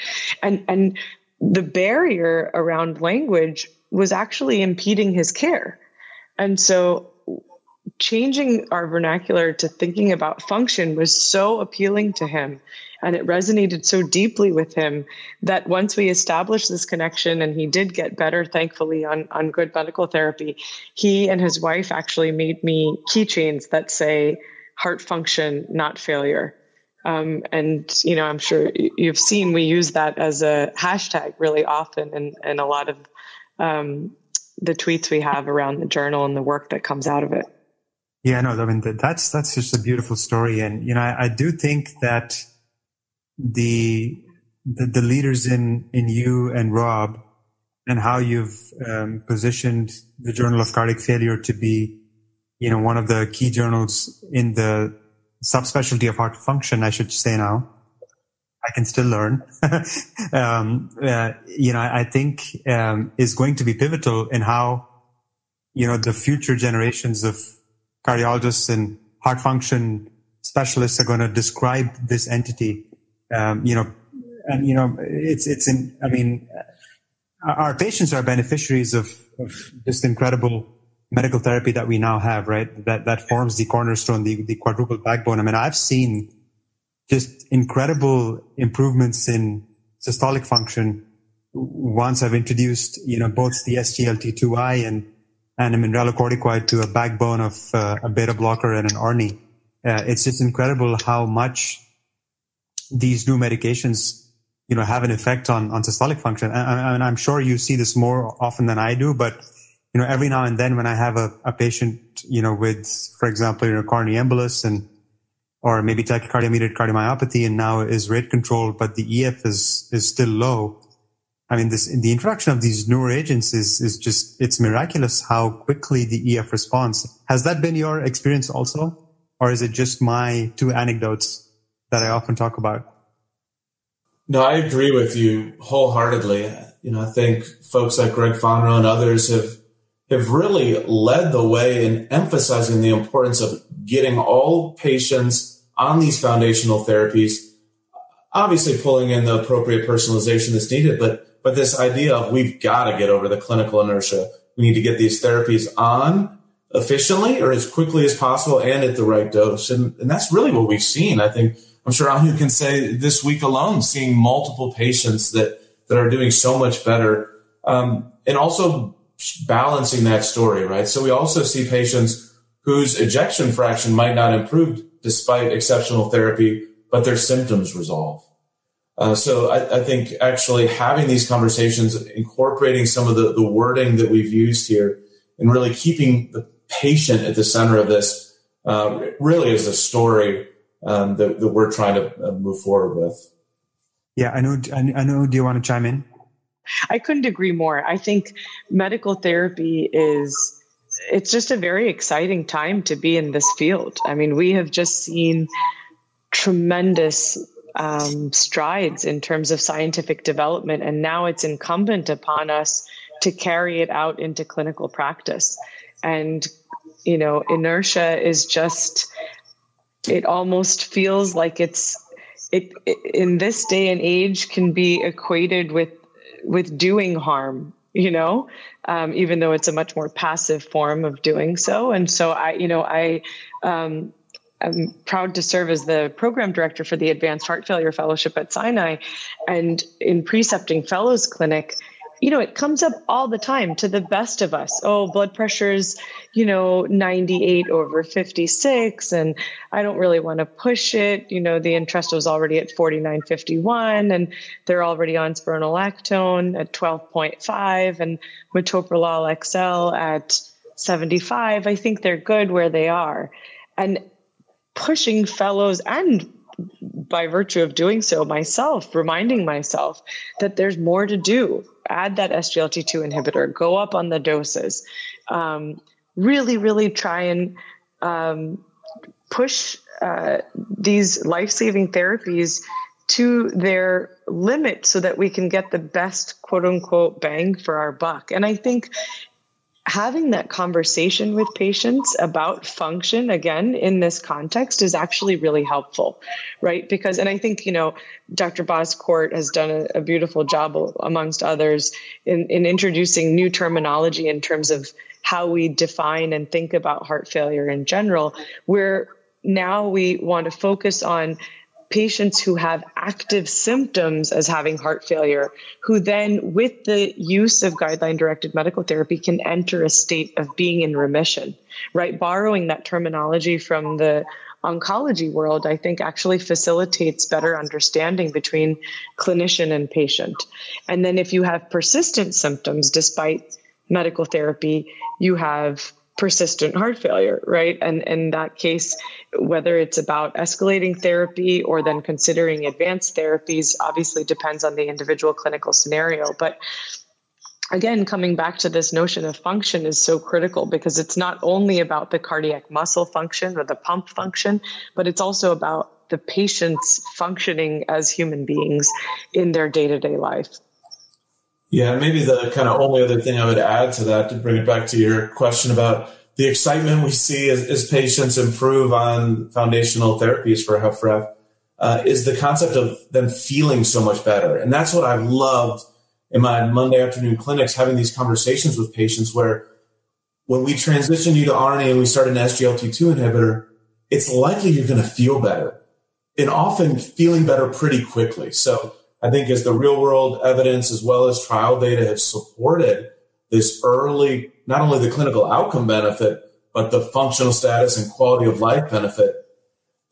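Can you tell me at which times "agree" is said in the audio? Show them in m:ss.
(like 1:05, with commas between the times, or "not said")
2:14, 3:17.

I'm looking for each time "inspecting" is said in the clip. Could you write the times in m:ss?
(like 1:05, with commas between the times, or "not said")
not said.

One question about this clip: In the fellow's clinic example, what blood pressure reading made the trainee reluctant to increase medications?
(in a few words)
98 over 56.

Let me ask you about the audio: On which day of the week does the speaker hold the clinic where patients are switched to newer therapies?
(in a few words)
Monday.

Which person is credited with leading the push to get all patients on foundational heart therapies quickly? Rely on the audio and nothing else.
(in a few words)
Greg Fonarow.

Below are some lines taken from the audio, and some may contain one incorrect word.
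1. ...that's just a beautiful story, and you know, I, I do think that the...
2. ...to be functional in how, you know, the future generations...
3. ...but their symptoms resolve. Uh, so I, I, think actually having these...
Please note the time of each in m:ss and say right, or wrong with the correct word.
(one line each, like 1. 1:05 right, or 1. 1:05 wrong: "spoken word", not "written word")
1. 0:39 right
2. 1:03 wrong: "pivotal", not "functional"
3. 2:56 right.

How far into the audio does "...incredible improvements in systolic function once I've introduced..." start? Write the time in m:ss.
1:27.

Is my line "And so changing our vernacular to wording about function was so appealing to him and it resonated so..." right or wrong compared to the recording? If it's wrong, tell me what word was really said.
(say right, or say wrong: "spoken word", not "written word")
wrong: "thinking", not "wording".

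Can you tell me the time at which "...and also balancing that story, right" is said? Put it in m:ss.
2:48.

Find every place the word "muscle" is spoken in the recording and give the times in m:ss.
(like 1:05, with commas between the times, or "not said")
5:52.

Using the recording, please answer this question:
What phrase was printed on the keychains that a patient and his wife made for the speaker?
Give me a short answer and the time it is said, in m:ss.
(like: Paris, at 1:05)
heart function, not failure, at 0:24.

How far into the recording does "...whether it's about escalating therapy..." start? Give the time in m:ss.
5:39.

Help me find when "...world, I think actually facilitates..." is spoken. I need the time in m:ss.
5:25.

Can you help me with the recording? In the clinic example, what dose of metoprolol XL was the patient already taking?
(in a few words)
75.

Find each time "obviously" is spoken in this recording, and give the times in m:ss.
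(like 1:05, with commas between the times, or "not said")
2:28, 5:43.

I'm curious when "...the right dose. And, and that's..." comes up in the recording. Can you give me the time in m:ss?
2:38.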